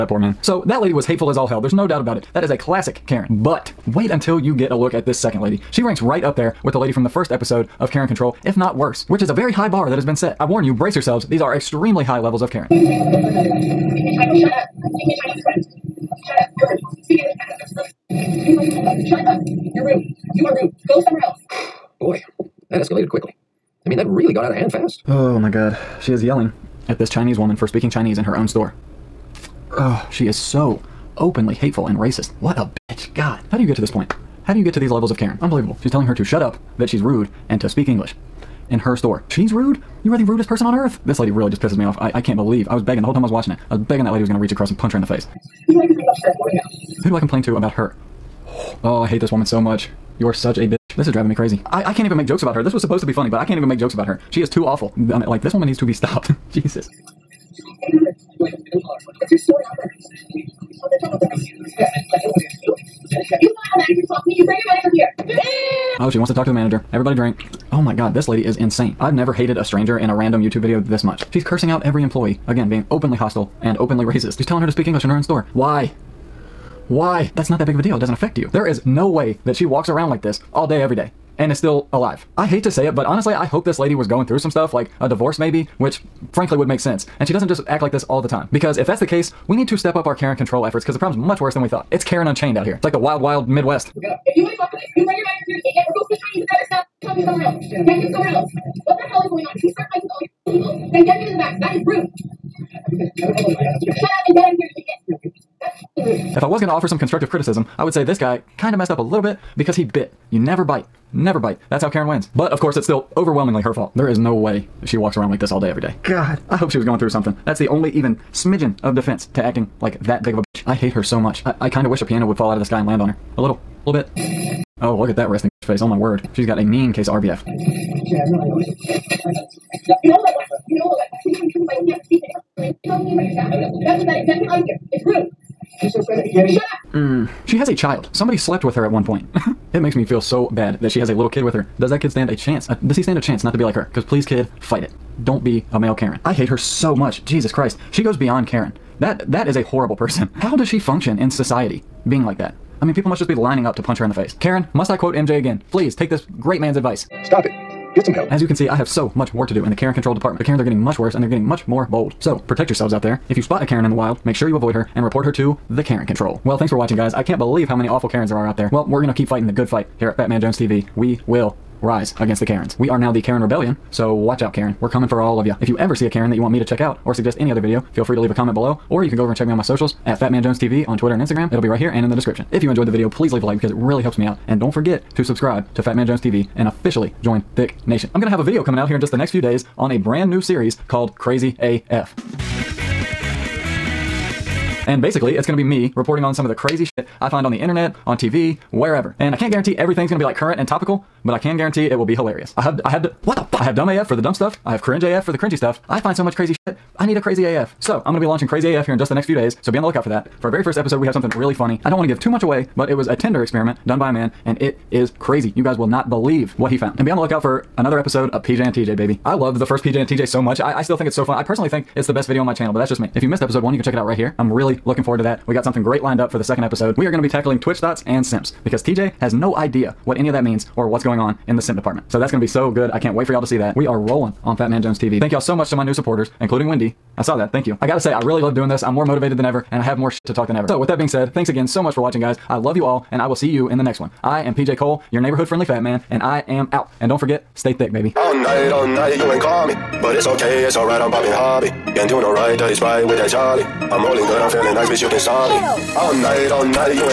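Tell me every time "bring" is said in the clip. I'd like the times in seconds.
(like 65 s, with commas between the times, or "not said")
64 s, 95 s.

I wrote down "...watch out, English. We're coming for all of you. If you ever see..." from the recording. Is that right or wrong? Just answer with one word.
wrong.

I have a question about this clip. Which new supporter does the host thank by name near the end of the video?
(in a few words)
Wendy.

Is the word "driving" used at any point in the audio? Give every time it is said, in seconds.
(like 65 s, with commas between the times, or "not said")
51 s.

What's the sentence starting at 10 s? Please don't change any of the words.
I warn you, brace yourselves, these are extremely high levels of Karen.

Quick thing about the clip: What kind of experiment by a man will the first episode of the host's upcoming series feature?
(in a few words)
Tinder experiment.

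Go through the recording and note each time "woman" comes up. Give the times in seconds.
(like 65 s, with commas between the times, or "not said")
27 s, 49 s, 55 s.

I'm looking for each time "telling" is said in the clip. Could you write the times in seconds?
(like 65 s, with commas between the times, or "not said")
35 s, 74 s.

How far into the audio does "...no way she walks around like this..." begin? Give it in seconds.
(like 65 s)
114 s.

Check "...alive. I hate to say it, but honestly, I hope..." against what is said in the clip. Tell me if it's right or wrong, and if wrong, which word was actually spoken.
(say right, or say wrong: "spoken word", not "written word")
right.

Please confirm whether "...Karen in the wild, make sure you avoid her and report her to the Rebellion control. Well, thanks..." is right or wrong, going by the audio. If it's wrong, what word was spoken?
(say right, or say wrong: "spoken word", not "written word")
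wrong: "Karen", not "Rebellion".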